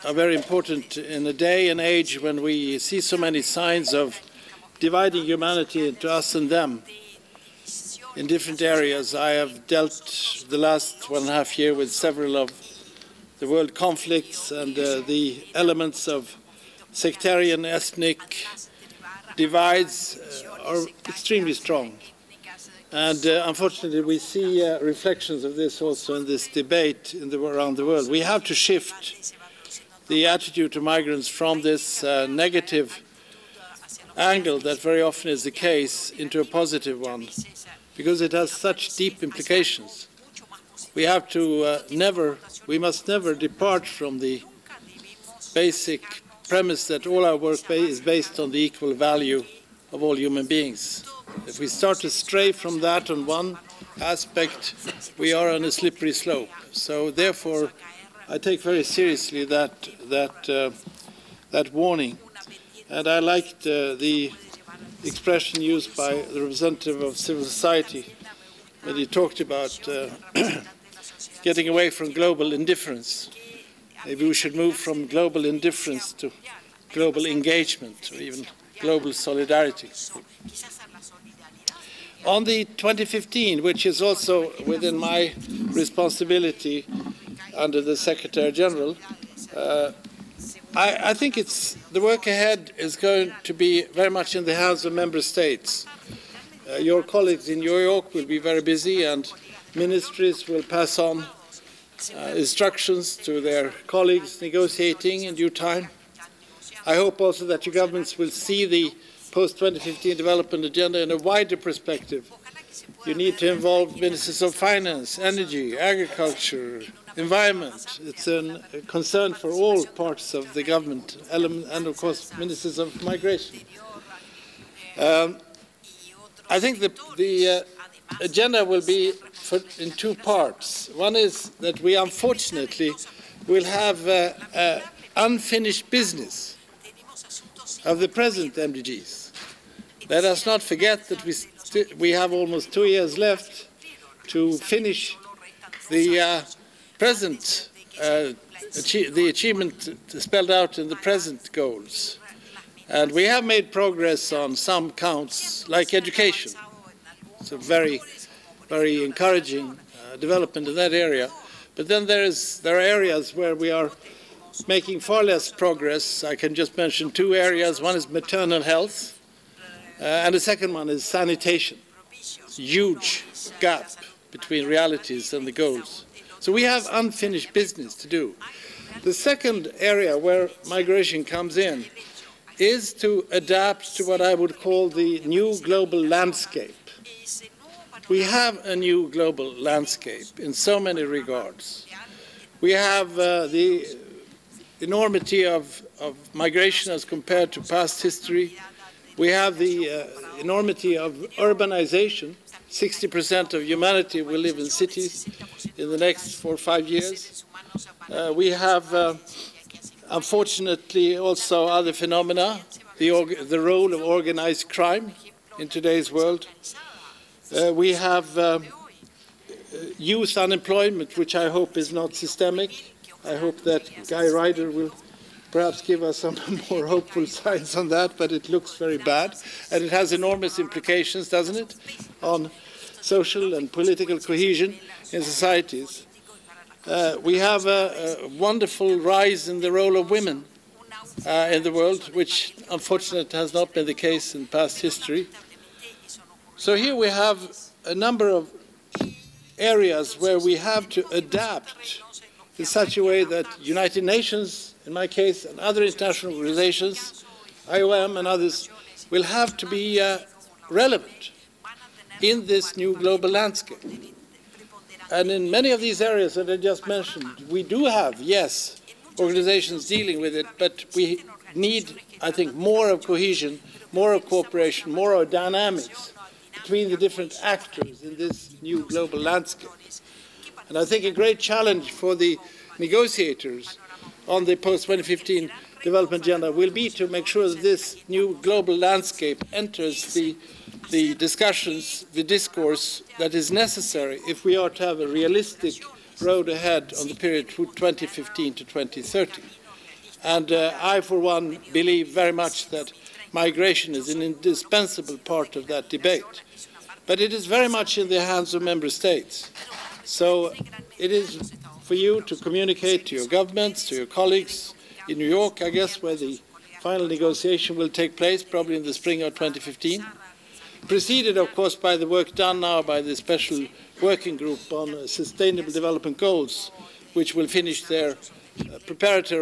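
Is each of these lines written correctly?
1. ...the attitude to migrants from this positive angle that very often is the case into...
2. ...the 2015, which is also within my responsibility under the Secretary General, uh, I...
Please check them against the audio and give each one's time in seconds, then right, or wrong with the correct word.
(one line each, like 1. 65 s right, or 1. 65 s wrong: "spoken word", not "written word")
1. 30 s wrong: "negative", not "positive"
2. 82 s right.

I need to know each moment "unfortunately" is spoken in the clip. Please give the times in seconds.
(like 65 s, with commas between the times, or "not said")
23 s, 131 s, 210 s, 242 s.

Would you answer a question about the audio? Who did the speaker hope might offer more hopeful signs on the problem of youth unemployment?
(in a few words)
Guy Ryder.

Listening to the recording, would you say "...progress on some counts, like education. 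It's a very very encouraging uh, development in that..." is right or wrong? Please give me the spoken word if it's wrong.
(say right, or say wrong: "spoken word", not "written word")
right.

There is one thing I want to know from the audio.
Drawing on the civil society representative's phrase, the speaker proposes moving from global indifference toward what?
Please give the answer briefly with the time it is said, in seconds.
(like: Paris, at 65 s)
global engagement, at 76 s.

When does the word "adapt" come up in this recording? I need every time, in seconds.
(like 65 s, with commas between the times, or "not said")
183 s, 251 s.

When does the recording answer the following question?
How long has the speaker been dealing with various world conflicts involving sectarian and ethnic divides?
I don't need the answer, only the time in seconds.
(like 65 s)
11 s.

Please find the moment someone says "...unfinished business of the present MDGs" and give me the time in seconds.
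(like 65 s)
135 s.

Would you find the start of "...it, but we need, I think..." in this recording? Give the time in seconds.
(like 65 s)
270 s.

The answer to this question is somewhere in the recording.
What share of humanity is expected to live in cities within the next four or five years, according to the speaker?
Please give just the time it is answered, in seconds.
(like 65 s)
202 s.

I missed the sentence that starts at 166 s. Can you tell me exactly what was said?
I can just mention two areas.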